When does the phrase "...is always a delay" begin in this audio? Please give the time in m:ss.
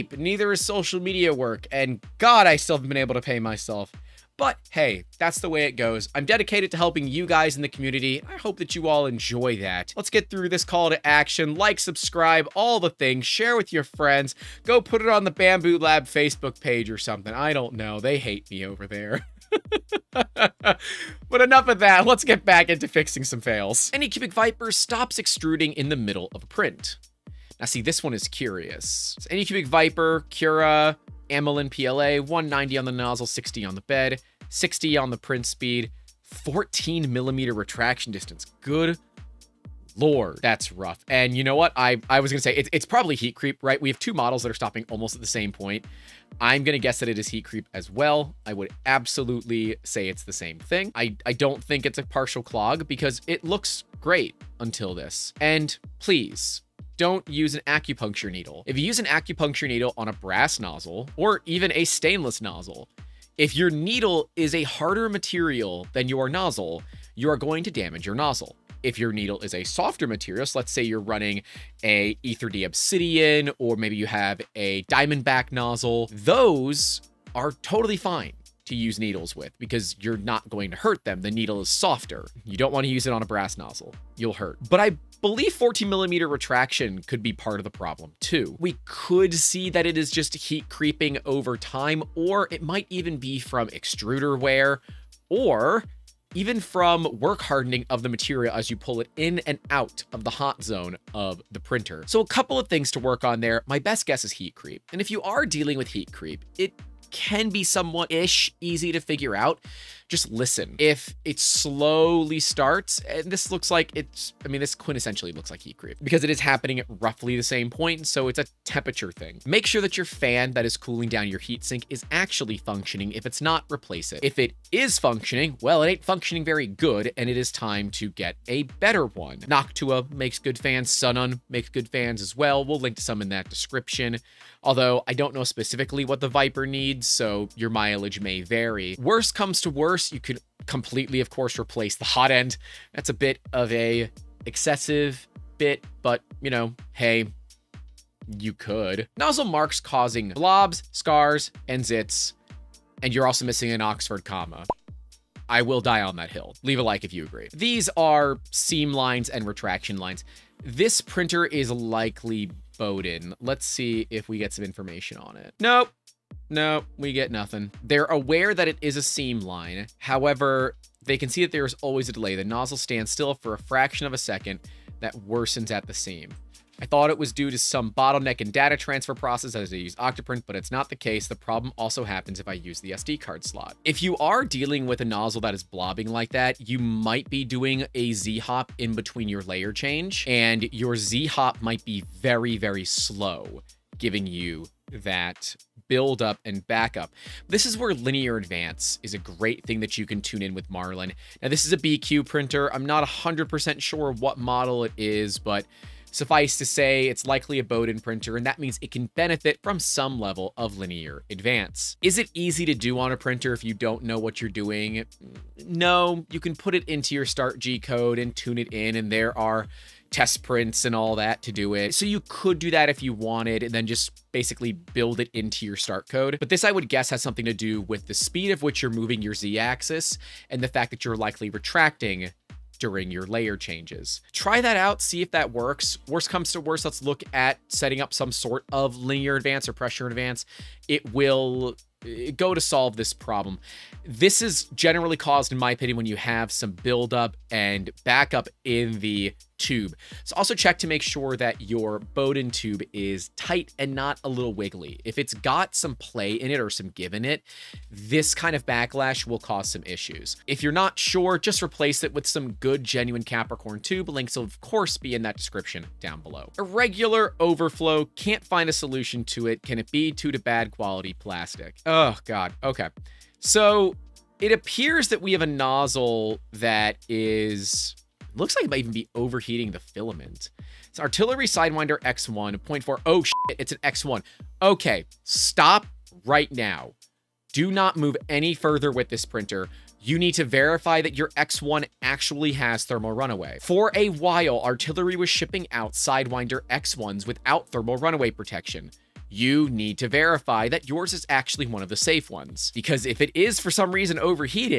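2:51.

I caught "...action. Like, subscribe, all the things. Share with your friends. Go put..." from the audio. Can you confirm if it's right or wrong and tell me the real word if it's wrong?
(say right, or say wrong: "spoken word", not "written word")
right.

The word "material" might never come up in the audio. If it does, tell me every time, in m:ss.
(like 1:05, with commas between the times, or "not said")
1:05, 1:10, 1:38.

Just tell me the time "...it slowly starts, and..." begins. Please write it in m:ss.
1:51.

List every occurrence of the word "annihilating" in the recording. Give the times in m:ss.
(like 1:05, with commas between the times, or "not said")
not said.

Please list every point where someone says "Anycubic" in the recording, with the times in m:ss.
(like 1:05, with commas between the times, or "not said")
0:23, 0:29.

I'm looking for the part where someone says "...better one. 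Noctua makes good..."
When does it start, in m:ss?
2:08.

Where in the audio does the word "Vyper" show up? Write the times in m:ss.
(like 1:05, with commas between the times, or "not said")
0:24, 0:29, 2:16.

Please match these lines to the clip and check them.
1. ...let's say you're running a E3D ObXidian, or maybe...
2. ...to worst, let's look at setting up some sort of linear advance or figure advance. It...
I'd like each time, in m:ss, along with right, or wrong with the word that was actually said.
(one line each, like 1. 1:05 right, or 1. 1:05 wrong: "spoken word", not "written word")
1. 1:10 right
2. 3:56 wrong: "pressure", not "figure".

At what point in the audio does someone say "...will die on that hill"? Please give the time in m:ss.
2:35.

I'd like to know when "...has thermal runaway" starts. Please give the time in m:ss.
4:52.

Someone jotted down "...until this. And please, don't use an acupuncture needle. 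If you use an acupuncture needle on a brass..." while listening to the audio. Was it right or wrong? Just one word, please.
right.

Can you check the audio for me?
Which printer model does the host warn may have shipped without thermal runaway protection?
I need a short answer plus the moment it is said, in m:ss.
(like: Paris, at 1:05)
Artillery Sidewinder X1, at 4:40.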